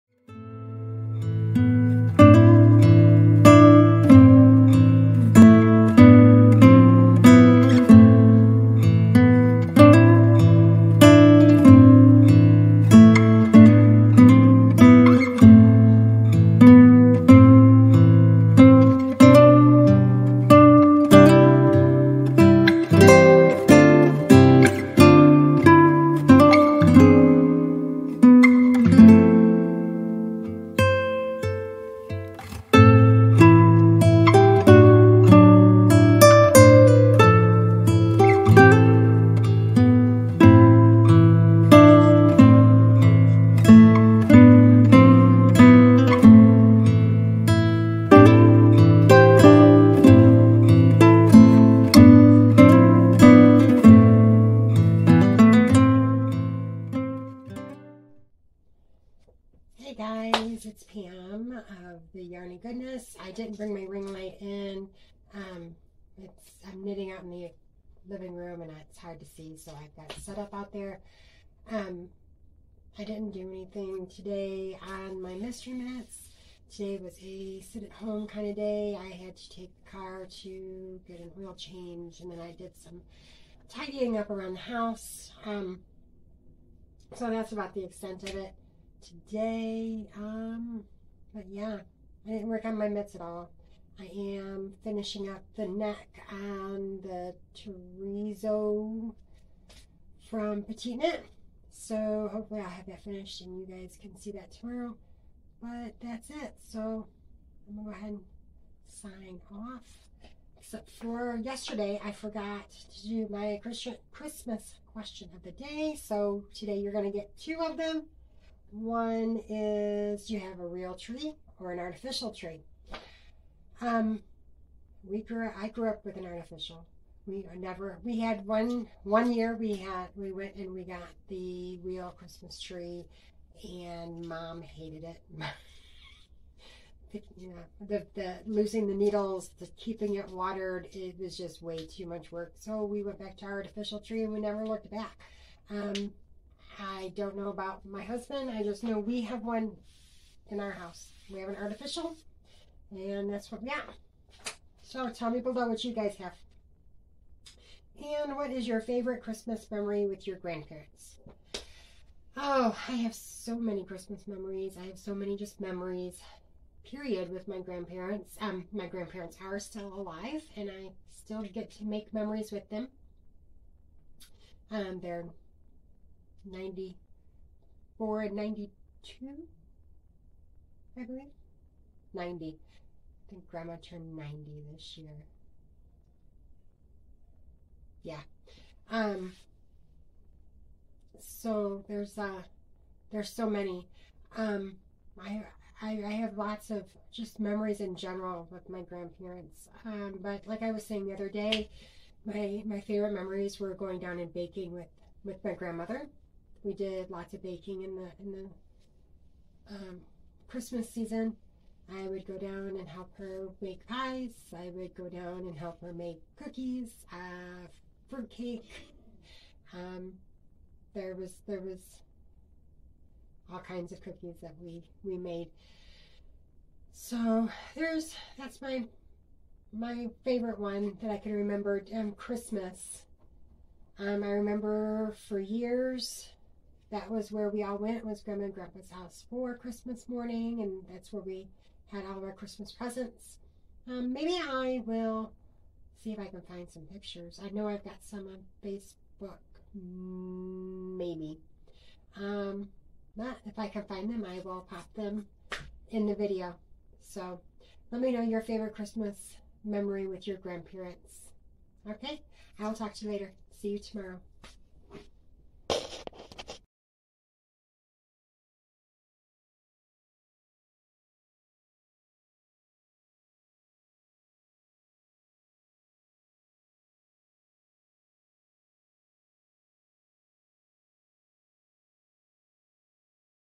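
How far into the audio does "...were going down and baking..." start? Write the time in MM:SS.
03:23.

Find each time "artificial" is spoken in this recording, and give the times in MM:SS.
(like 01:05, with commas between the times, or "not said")
02:01, 02:06, 02:23, 02:31.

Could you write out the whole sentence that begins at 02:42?
Oh, I have so many Christmas memories.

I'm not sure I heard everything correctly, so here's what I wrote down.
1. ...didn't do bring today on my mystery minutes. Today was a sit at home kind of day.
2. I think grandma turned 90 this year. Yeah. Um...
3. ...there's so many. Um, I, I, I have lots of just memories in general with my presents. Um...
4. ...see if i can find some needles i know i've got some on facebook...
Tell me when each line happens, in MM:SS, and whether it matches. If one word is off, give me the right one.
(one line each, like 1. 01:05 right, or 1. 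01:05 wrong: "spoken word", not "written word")
1. 01:13 wrong: "anything", not "bring"
2. 03:02 right
3. 03:13 wrong: "grandparents", not "presents"
4. 04:06 wrong: "pictures", not "needles".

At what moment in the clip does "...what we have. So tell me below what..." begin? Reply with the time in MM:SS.
02:33.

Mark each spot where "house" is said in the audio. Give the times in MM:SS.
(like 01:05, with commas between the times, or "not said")
01:24, 02:30, 03:58.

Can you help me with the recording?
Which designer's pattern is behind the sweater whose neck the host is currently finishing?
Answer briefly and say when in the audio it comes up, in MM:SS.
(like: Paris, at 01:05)
PetiteKnit, at 01:40.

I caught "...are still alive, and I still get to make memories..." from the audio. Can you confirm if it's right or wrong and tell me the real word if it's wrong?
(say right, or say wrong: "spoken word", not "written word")
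right.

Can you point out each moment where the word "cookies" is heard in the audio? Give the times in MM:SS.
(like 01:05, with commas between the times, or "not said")
03:36, 03:44.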